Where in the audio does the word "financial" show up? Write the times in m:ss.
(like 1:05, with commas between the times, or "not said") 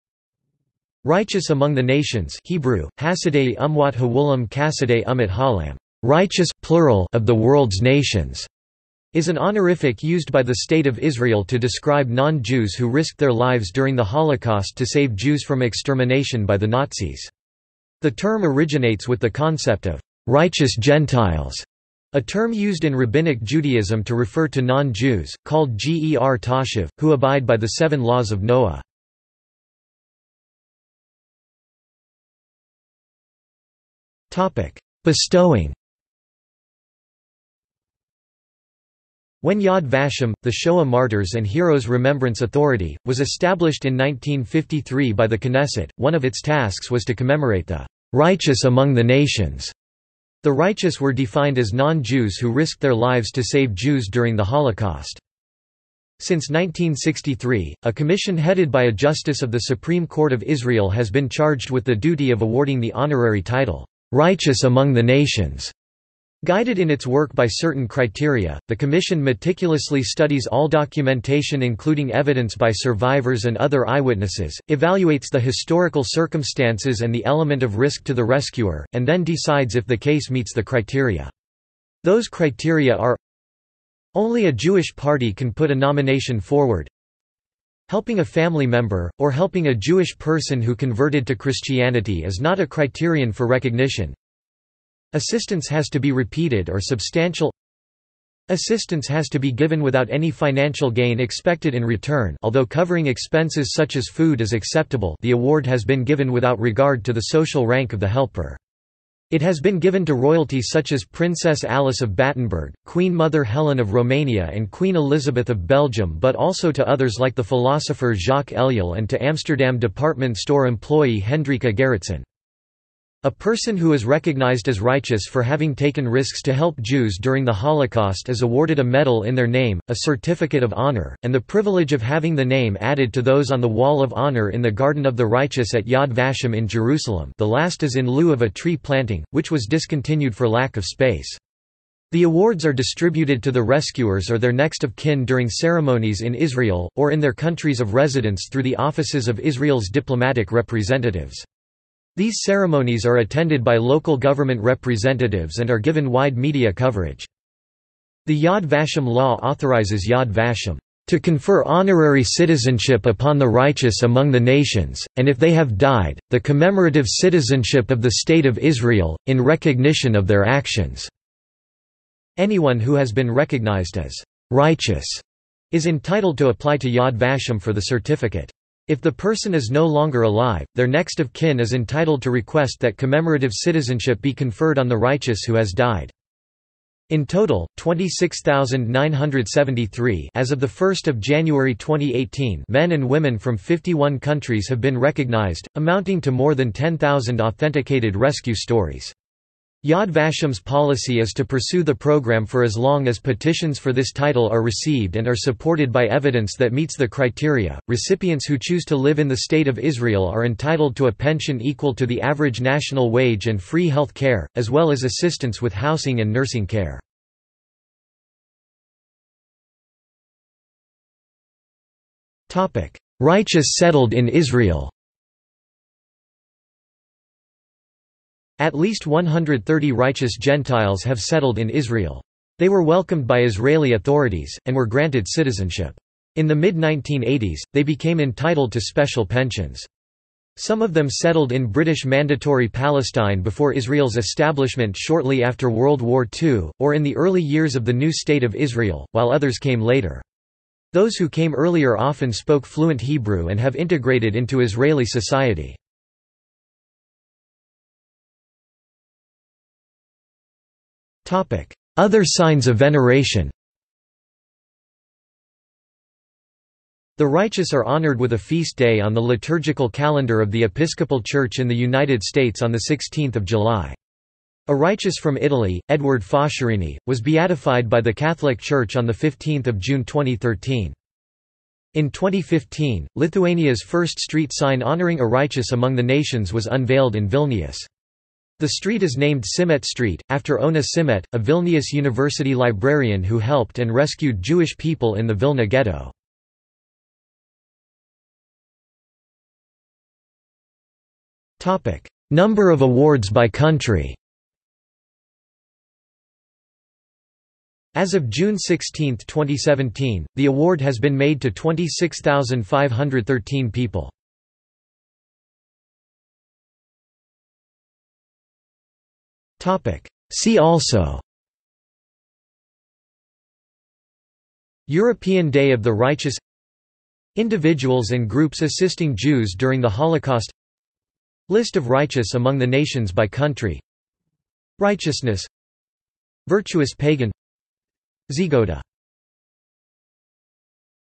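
1:40.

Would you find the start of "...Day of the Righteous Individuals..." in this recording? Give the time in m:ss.
5:25.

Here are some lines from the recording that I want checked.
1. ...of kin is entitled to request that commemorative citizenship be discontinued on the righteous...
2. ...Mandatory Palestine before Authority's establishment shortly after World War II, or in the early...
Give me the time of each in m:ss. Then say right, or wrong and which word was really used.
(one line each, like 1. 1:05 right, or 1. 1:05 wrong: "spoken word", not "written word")
1. 3:01 wrong: "conferred", not "discontinued"
2. 4:02 wrong: "Israel", not "Authority".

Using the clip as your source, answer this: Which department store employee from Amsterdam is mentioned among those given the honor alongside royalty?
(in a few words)
Hendrika Gerritsen.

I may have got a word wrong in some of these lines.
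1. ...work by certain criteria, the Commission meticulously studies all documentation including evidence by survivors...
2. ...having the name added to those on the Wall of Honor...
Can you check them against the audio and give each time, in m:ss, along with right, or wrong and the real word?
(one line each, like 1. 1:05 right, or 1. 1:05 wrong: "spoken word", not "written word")
1. 1:07 right
2. 2:12 right.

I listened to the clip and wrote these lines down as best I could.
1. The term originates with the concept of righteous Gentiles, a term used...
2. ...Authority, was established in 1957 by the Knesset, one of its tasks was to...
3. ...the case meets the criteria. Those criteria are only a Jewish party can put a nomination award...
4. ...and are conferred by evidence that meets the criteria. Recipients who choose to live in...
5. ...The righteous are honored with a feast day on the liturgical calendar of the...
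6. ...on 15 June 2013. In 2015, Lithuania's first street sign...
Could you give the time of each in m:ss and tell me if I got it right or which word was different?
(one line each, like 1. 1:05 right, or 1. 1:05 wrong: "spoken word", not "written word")
1. 0:18 right
2. 0:42 wrong: "1953", not "1957"
3. 1:19 wrong: "forward", not "award"
4. 3:25 wrong: "supported", not "conferred"
5. 4:27 right
6. 4:38 right.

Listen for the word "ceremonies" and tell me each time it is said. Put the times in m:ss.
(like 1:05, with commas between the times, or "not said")
2:25, 2:32.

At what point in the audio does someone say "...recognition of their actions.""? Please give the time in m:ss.
2:49.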